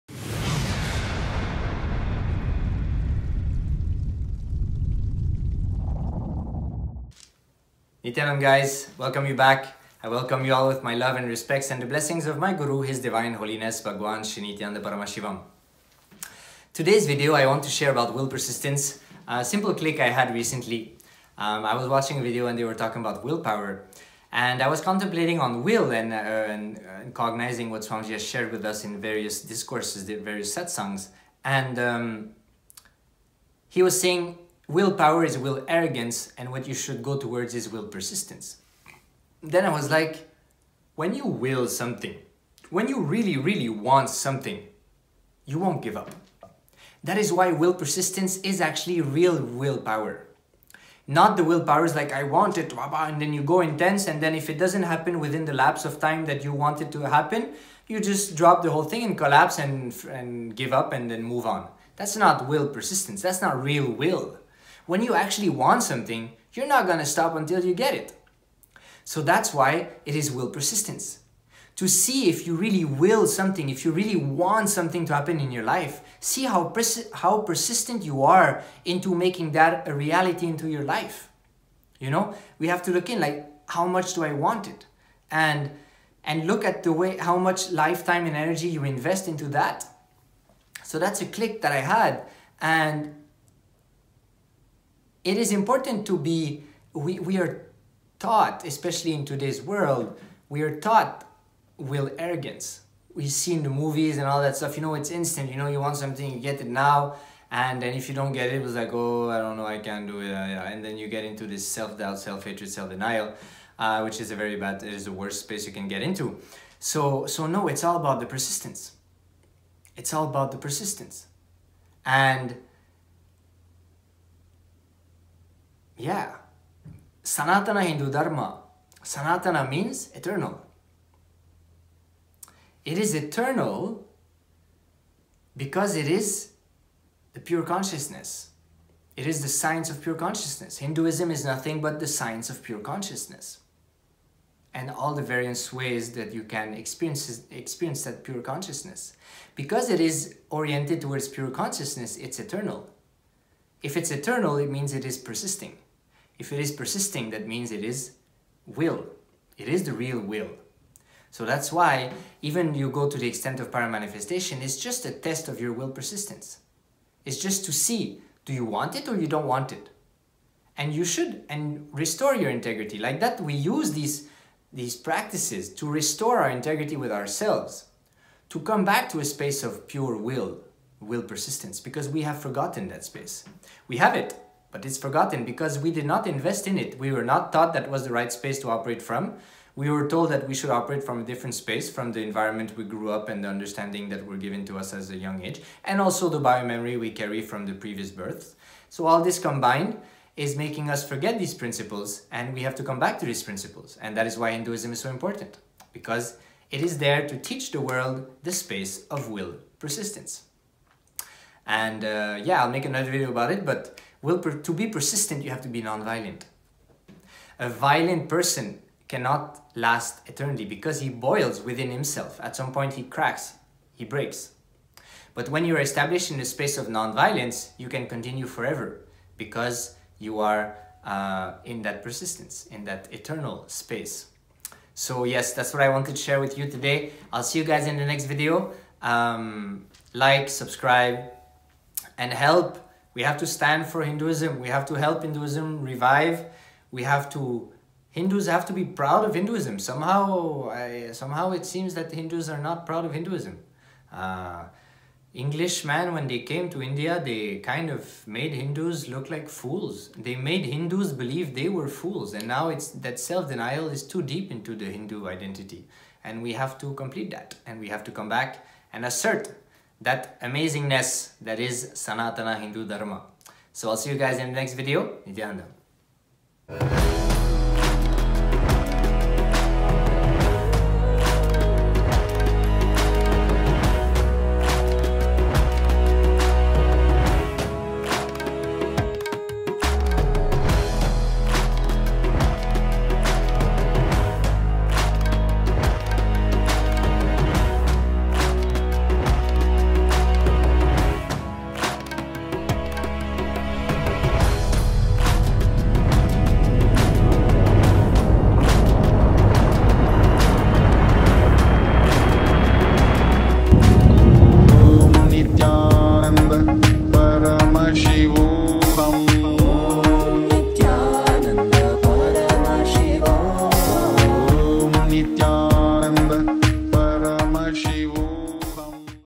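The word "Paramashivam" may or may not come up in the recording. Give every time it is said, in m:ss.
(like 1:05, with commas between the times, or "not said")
0:14.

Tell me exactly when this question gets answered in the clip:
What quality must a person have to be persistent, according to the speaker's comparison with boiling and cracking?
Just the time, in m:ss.
3:35.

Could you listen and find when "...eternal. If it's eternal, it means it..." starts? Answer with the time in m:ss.
2:32.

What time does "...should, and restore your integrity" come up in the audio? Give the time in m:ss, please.
2:51.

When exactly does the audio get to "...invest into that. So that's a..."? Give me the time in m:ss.
1:28.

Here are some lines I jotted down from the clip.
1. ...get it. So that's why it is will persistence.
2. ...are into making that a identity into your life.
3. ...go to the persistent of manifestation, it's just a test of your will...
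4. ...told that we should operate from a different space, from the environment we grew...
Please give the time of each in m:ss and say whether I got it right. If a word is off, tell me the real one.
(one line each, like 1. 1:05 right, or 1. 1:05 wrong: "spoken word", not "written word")
1. 1:07 right
2. 1:18 wrong: "reality", not "identity"
3. 2:42 wrong: "extent", not "persistent"
4. 3:10 right.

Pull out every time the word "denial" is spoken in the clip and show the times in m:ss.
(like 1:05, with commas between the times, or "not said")
1:52, 4:23.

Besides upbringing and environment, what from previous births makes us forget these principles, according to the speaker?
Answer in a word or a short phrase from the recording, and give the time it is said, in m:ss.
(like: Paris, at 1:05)
biomemory, at 3:16.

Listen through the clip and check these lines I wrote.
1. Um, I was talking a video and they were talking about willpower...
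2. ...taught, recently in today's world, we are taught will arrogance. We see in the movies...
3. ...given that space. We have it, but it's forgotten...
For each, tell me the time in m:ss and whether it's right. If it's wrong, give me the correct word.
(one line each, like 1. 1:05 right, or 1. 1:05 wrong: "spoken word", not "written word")
1. 0:21 wrong: "watching", not "talking"
2. 1:38 wrong: "especially", not "recently"
3. 3:02 wrong: "forgotten", not "given".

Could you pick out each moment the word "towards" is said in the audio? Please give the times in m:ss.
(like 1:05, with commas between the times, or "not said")
0:37, 2:31.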